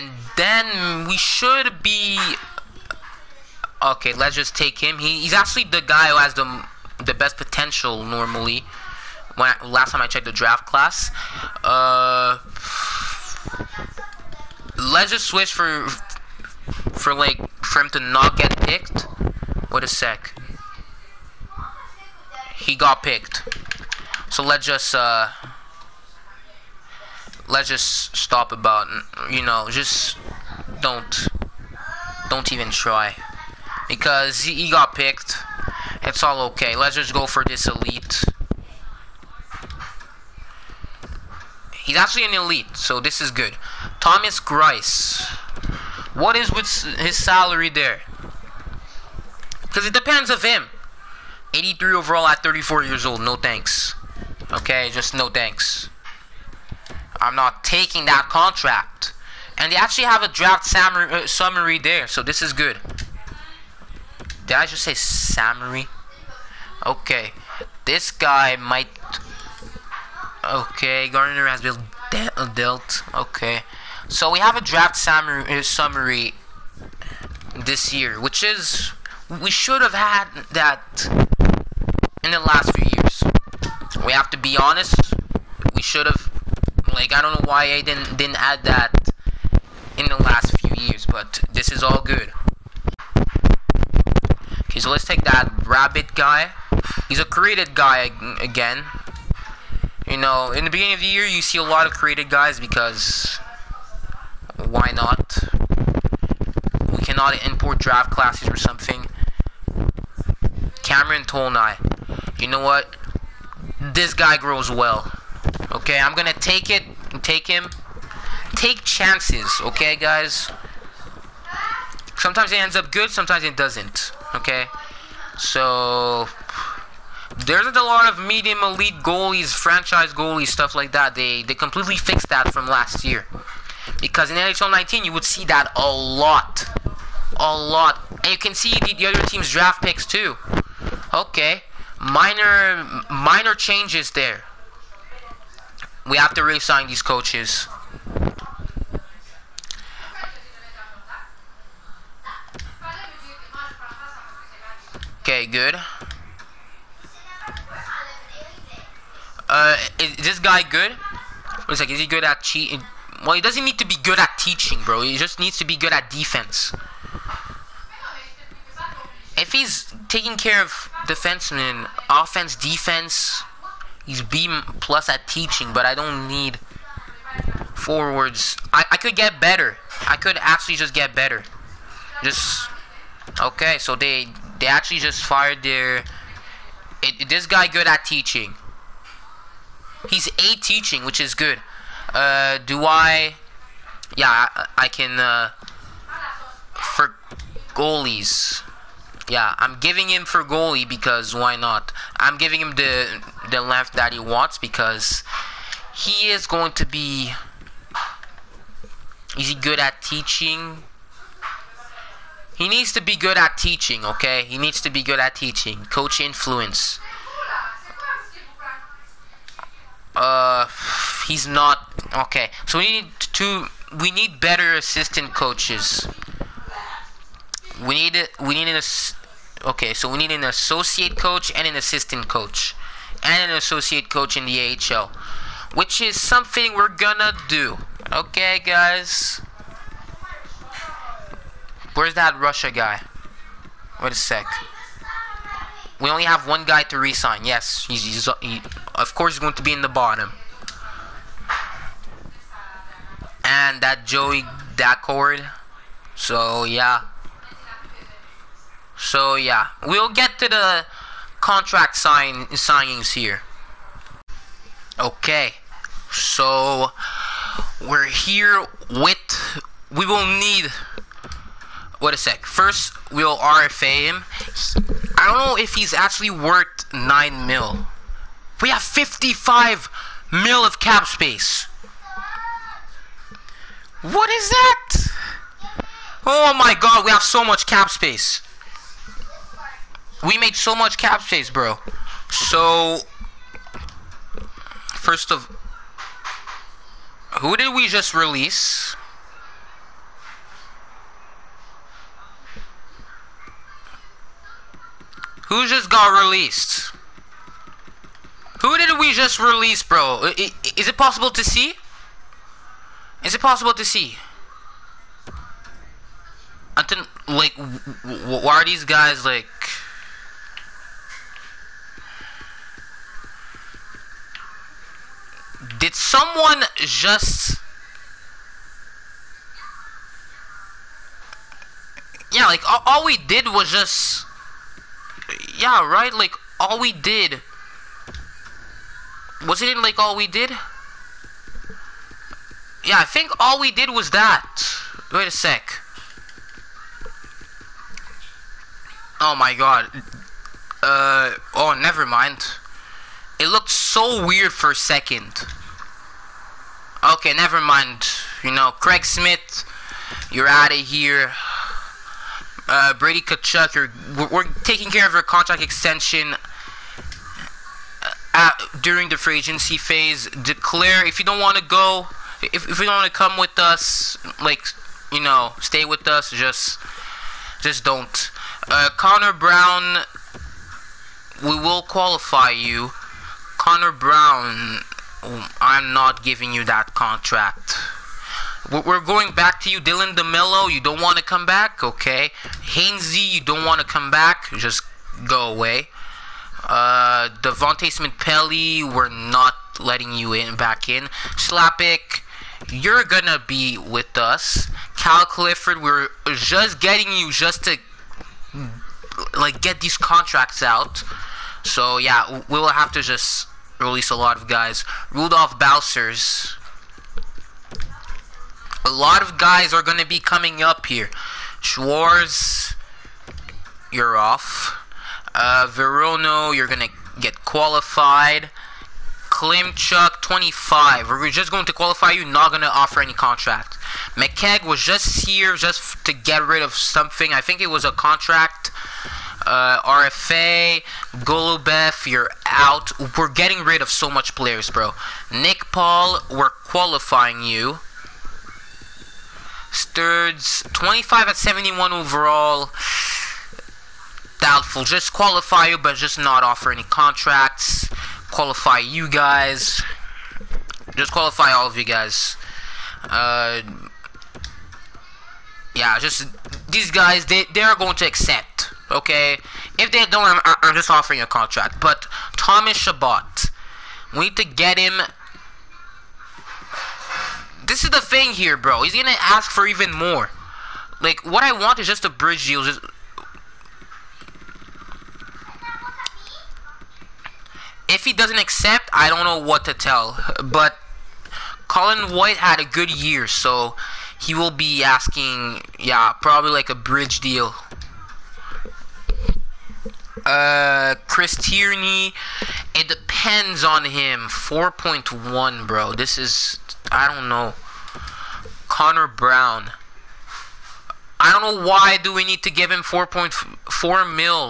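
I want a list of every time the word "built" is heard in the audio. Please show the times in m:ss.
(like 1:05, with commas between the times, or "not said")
1:11.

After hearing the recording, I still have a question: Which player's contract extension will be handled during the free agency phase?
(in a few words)
Brady Tkachuk.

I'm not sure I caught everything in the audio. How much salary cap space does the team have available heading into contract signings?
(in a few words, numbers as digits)
55 mil.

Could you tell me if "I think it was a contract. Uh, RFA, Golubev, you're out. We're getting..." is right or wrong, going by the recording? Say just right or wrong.
right.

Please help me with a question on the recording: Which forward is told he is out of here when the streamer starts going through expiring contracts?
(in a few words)
Craig Smith.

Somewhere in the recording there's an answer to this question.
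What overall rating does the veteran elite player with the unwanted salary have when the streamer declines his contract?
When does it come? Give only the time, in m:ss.
0:51.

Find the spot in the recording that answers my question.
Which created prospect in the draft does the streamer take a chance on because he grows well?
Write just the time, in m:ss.
1:50.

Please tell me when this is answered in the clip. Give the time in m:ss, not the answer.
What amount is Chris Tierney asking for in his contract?
8:24.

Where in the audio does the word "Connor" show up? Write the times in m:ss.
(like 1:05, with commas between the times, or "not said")
6:18, 6:23, 8:28.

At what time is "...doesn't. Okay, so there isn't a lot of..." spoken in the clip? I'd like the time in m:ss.
2:03.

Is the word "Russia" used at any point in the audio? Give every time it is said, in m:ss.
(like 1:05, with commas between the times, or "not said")
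4:02.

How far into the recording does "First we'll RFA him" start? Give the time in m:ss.
4:32.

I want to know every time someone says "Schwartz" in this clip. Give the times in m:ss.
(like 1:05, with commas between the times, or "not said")
7:01.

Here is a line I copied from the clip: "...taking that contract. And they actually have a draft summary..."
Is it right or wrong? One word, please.
right.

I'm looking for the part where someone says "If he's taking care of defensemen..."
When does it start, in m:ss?
2:49.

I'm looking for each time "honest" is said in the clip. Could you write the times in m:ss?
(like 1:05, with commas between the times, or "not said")
1:24.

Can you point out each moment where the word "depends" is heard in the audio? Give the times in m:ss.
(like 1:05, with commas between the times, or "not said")
0:49, 8:22.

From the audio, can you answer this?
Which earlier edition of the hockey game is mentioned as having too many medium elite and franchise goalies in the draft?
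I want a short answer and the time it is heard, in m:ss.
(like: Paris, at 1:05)
NHL 19, at 2:14.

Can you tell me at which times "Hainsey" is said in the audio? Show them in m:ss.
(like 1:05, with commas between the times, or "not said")
6:32.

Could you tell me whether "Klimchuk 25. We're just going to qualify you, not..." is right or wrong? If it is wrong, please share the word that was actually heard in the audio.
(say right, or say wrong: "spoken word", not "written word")
right.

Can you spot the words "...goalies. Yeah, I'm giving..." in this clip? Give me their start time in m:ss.
3:17.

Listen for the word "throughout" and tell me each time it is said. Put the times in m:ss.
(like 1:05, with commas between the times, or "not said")
not said.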